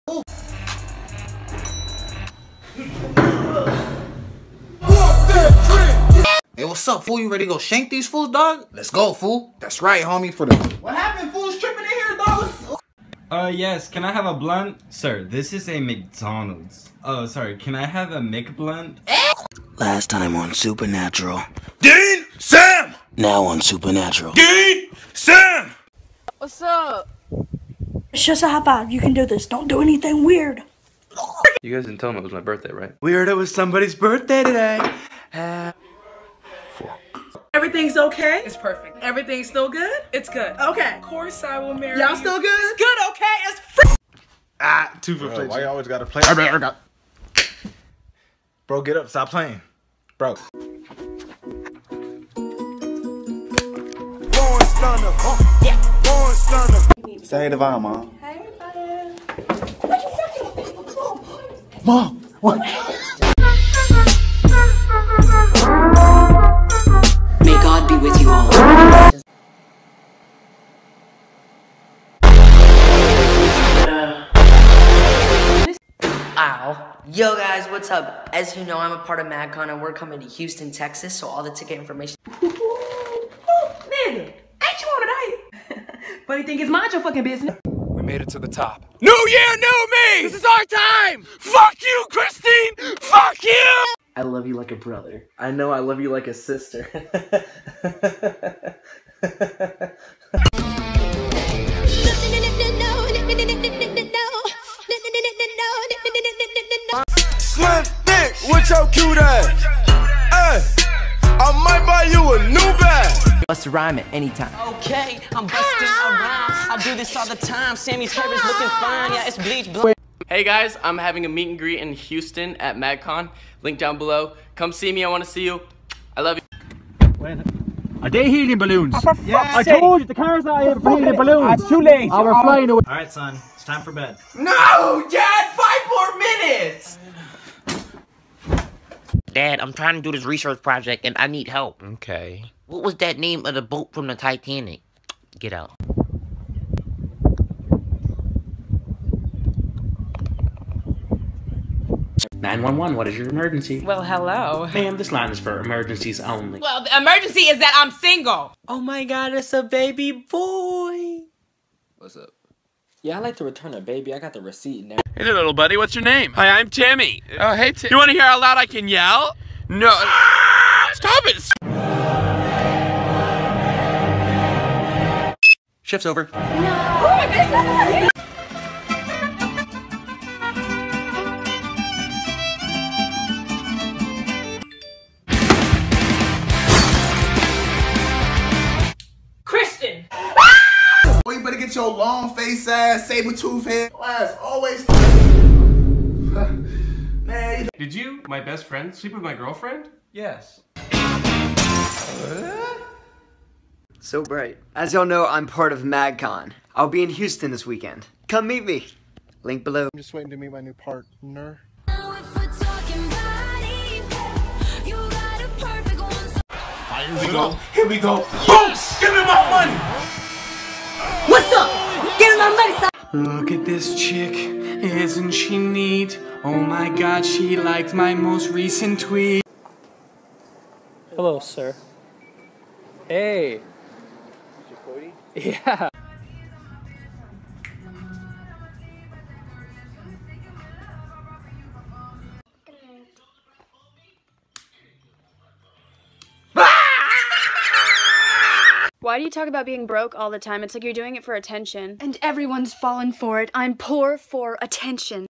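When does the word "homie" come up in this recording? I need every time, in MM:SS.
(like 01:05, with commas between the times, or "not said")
00:10.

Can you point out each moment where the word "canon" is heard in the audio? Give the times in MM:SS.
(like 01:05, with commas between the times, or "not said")
not said.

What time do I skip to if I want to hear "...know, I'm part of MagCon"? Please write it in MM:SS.
03:25.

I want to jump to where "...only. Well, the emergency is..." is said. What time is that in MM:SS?
02:36.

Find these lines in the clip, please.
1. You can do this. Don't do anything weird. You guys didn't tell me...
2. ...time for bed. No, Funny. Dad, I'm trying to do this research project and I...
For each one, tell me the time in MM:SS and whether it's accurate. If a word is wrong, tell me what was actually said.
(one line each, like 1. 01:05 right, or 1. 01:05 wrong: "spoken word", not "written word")
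1. 00:28 right
2. 02:13 wrong: "Dad", not "Funny".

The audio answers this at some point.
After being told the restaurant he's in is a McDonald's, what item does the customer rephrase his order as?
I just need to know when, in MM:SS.
00:18.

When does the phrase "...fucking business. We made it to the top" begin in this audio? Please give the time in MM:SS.
01:27.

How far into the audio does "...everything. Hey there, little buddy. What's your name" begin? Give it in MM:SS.
02:44.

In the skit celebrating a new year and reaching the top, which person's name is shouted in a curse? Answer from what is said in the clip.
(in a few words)
Christine.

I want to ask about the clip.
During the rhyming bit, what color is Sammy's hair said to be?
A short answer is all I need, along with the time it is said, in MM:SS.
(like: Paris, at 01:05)
Bleach blue, at 01:59.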